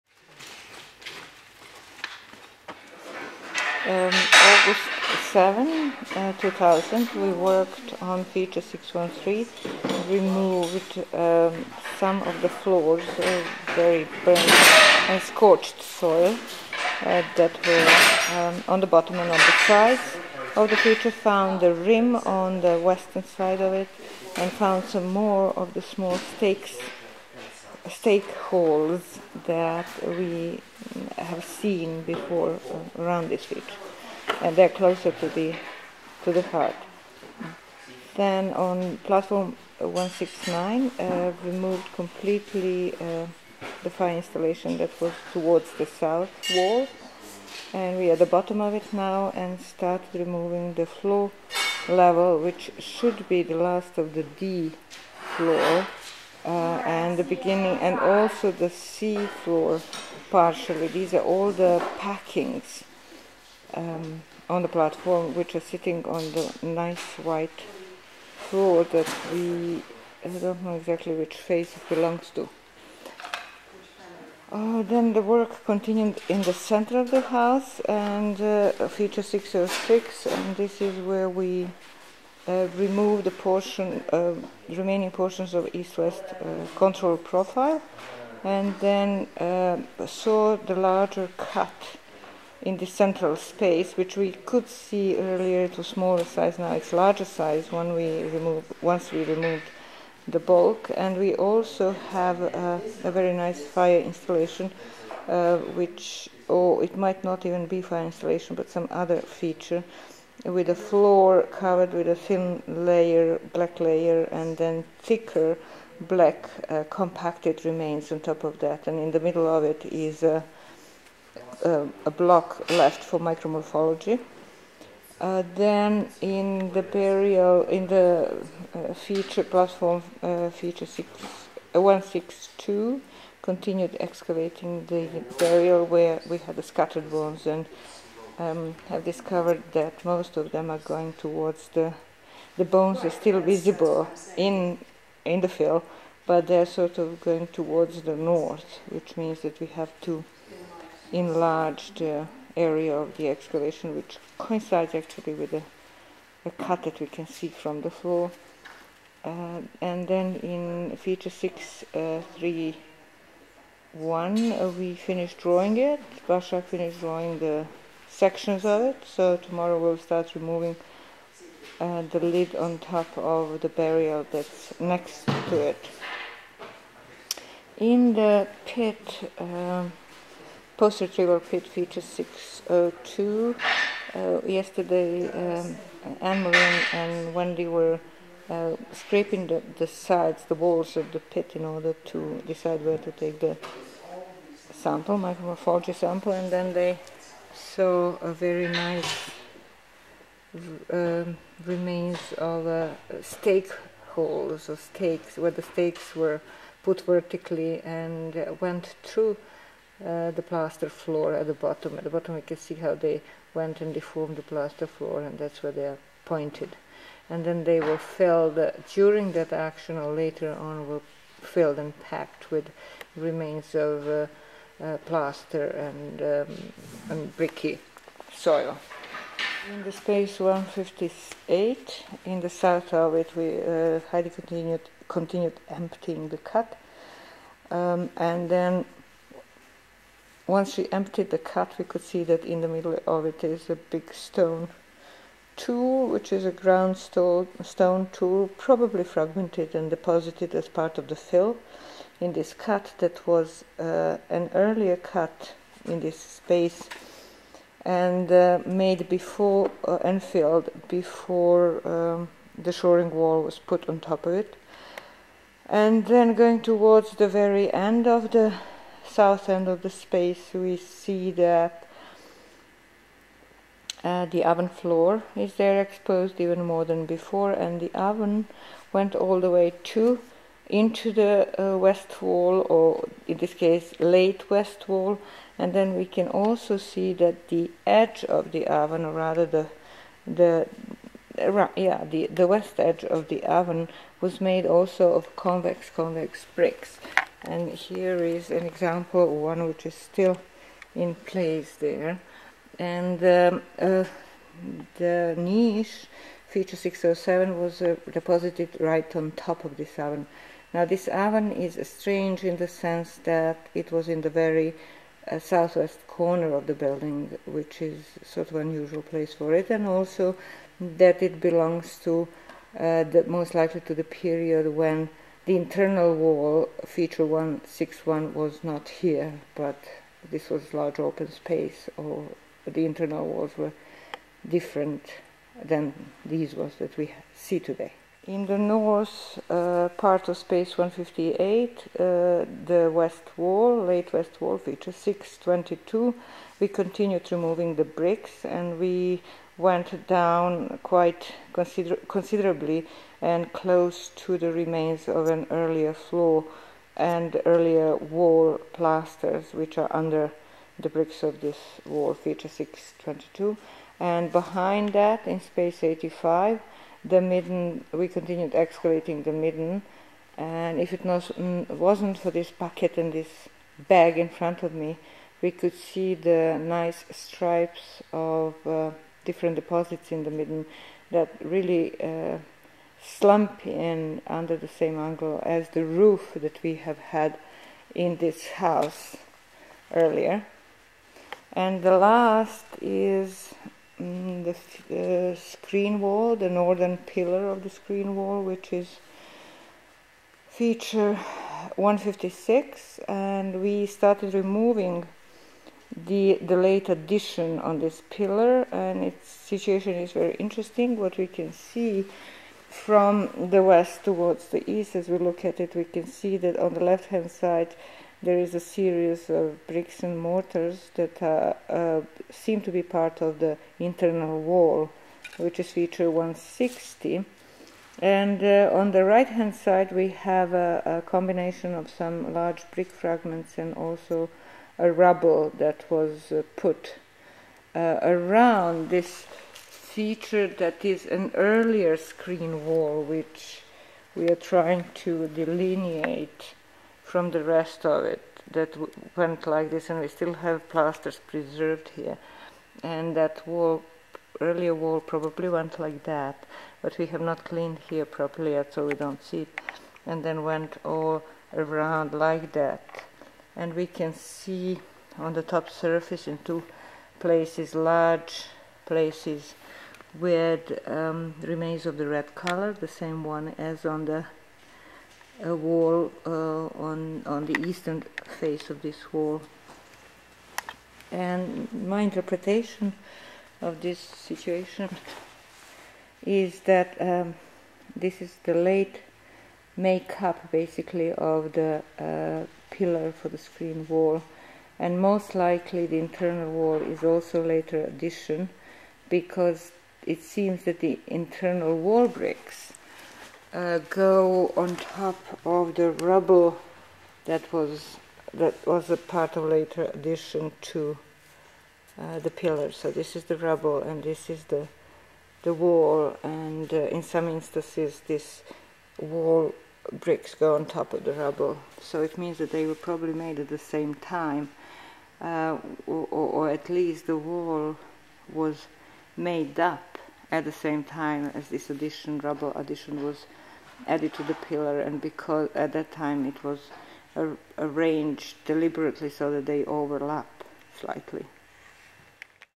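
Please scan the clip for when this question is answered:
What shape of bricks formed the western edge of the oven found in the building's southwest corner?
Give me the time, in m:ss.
4:55.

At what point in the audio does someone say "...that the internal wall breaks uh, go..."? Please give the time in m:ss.
8:20.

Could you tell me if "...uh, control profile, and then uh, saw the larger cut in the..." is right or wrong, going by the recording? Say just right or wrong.
right.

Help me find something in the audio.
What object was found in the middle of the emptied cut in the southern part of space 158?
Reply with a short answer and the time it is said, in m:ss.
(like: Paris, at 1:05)
ground stone tool, at 4:06.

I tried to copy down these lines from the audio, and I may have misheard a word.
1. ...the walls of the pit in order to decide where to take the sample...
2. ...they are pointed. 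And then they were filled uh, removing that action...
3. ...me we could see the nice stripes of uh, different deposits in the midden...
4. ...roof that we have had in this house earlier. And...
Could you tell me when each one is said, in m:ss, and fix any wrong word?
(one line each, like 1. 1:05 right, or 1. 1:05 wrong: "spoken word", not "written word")
1. 3:10 right
2. 3:35 wrong: "during", not "removing"
3. 6:14 right
4. 6:25 right.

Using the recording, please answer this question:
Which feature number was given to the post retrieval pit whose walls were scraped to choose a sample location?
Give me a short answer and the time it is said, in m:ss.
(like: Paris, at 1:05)
602, at 3:01.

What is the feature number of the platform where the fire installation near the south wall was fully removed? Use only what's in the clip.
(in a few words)
169.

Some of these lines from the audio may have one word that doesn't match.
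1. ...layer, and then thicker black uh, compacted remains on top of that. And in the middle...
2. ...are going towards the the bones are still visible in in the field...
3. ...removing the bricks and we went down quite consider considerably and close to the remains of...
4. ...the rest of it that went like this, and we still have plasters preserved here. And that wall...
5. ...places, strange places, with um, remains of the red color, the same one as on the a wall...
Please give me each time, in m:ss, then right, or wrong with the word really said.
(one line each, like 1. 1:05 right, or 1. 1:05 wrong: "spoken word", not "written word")
1. 1:53 right
2. 2:20 right
3. 5:47 right
4. 7:27 right
5. 7:47 wrong: "large", not "strange".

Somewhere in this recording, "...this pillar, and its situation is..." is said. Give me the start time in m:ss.
6:47.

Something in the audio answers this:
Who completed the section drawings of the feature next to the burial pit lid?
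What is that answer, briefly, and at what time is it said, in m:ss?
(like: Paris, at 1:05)
Bashak, at 2:46.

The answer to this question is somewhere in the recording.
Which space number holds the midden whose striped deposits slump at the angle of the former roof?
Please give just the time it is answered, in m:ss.
6:05.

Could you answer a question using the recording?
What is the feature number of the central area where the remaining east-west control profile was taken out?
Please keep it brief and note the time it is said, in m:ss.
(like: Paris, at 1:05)
606, at 1:18.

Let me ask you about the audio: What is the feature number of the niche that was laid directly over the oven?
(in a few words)
607.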